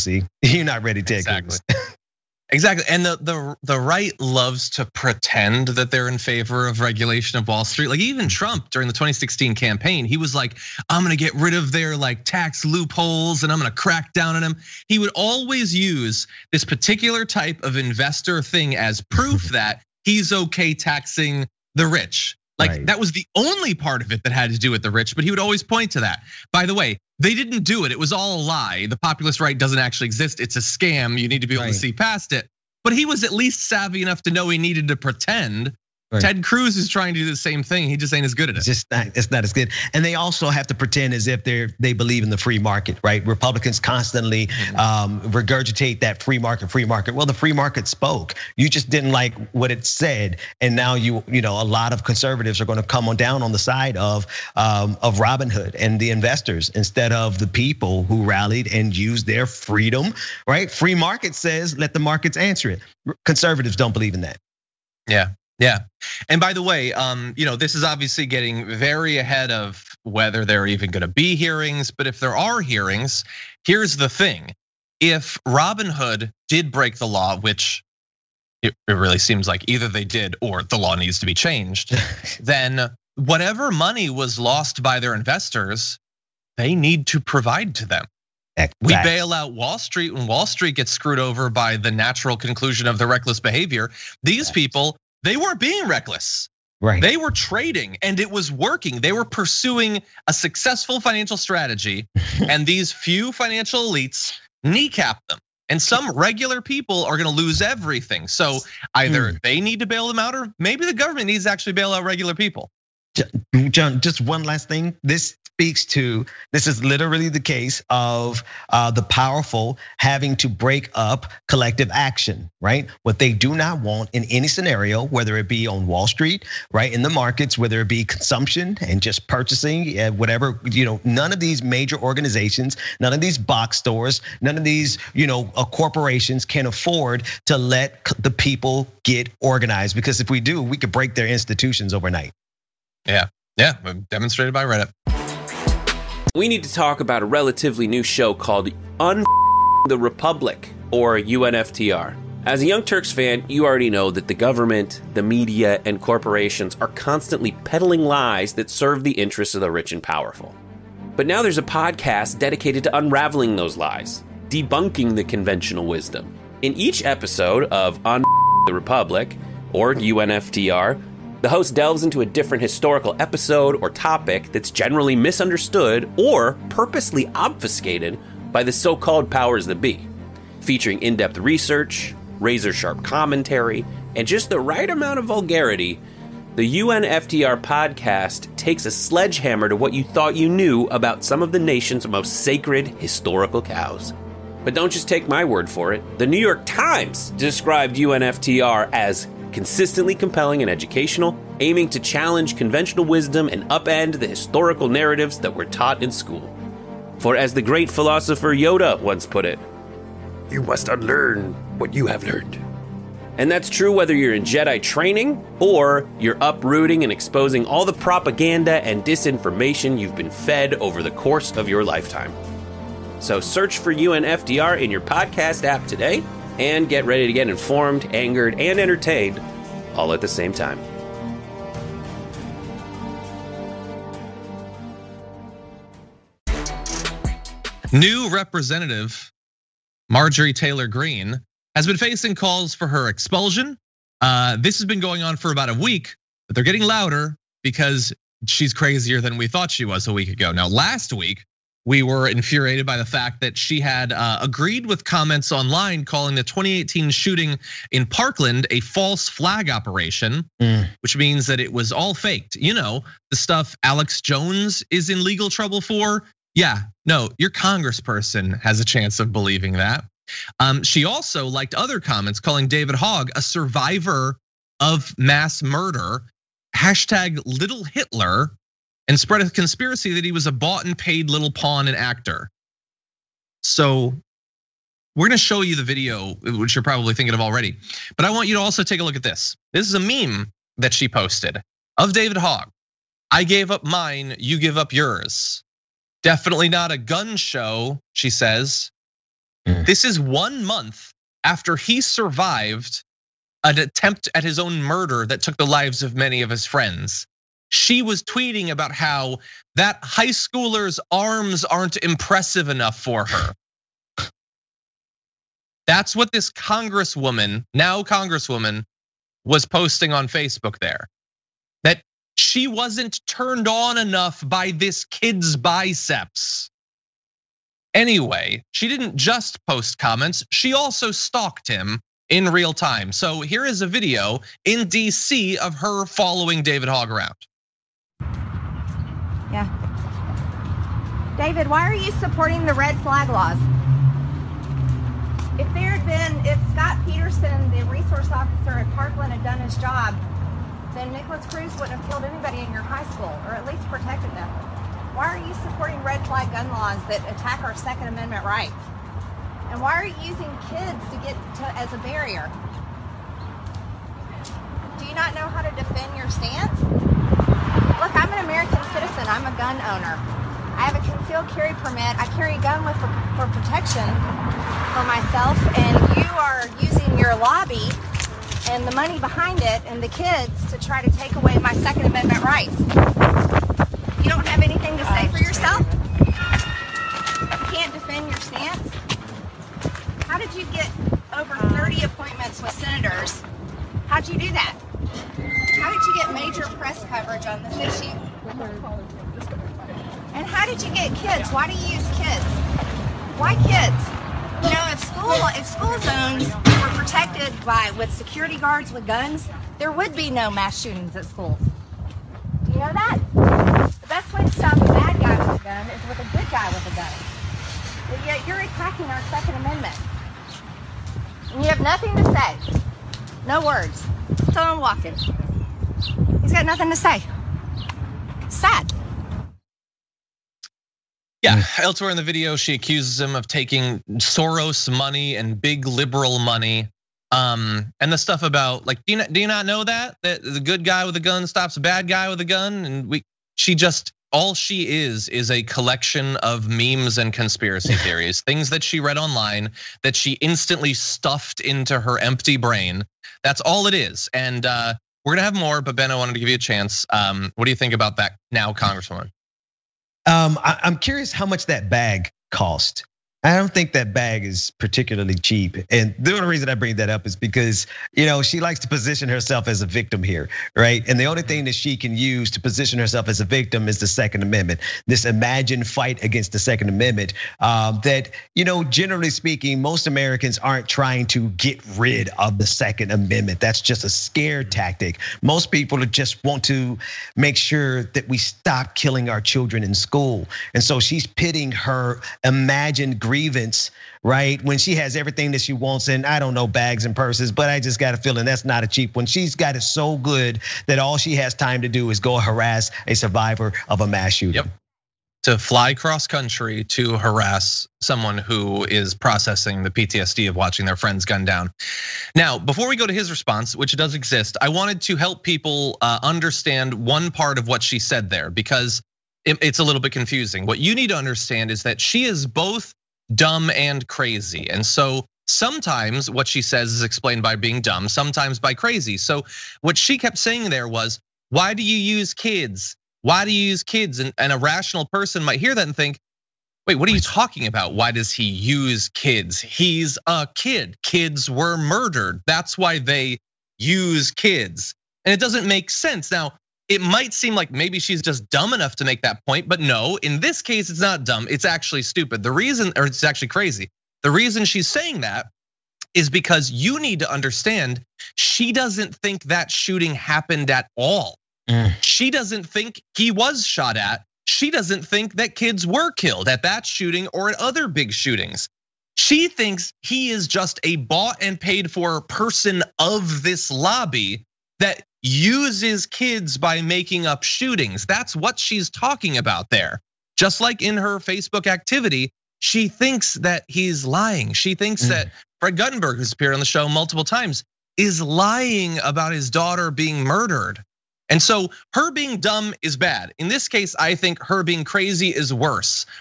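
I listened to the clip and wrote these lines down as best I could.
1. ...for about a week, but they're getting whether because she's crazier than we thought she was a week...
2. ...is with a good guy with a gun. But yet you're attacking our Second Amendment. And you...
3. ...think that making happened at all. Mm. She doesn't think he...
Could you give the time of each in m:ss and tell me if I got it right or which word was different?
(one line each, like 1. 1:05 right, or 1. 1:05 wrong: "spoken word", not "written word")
1. 4:05 wrong: "louder", not "whether"
2. 6:55 right
3. 9:19 wrong: "shooting", not "making".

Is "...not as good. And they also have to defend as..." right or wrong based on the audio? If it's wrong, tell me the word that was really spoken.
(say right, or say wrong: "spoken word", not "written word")
wrong: "pretend", not "defend".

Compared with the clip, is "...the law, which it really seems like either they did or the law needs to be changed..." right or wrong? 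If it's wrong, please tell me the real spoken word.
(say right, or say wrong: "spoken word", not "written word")
right.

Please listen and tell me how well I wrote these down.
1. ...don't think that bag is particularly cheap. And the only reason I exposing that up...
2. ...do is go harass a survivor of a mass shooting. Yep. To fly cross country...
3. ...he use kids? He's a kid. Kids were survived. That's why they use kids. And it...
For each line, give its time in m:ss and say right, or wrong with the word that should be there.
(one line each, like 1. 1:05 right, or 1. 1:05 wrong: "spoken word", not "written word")
1. 7:43 wrong: "bring", not "exposing"
2. 8:21 right
3. 8:58 wrong: "murdered", not "survived".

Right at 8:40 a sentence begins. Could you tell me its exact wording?
What you need to understand is that she is both dumb and crazy.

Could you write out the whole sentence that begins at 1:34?
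These people they weren't being reckless.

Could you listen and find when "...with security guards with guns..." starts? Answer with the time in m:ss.
6:47.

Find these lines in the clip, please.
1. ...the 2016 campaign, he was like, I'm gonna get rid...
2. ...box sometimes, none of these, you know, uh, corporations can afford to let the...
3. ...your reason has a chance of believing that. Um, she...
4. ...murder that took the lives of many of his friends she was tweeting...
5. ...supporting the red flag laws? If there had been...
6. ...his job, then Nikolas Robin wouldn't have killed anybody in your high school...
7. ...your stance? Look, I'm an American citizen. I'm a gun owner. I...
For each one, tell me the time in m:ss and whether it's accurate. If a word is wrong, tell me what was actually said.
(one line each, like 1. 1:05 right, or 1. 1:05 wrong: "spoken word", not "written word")
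1. 0:08 right
2. 2:13 wrong: "stores", not "sometimes"
3. 4:27 wrong: "congressperson", not "reason"
4. 5:04 right
5. 5:42 right
6. 5:49 wrong: "Cruz", not "Robin"
7. 6:06 right.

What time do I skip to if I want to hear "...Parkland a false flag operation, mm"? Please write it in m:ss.
4:18.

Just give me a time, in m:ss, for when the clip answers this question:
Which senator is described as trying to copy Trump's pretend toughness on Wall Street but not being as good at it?
0:36.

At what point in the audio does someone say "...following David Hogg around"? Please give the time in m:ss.
5:36.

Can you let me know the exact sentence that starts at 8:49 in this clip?
So what she kept saying there was, why do you use kids?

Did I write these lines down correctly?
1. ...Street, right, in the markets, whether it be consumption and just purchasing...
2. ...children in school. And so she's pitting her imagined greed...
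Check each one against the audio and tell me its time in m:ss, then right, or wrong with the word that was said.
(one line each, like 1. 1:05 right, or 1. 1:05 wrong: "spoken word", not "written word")
1. 2:06 right
2. 8:09 right.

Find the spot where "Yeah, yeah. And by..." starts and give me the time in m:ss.
1:05.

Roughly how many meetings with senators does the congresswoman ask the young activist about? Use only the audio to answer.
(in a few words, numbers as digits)
over 30.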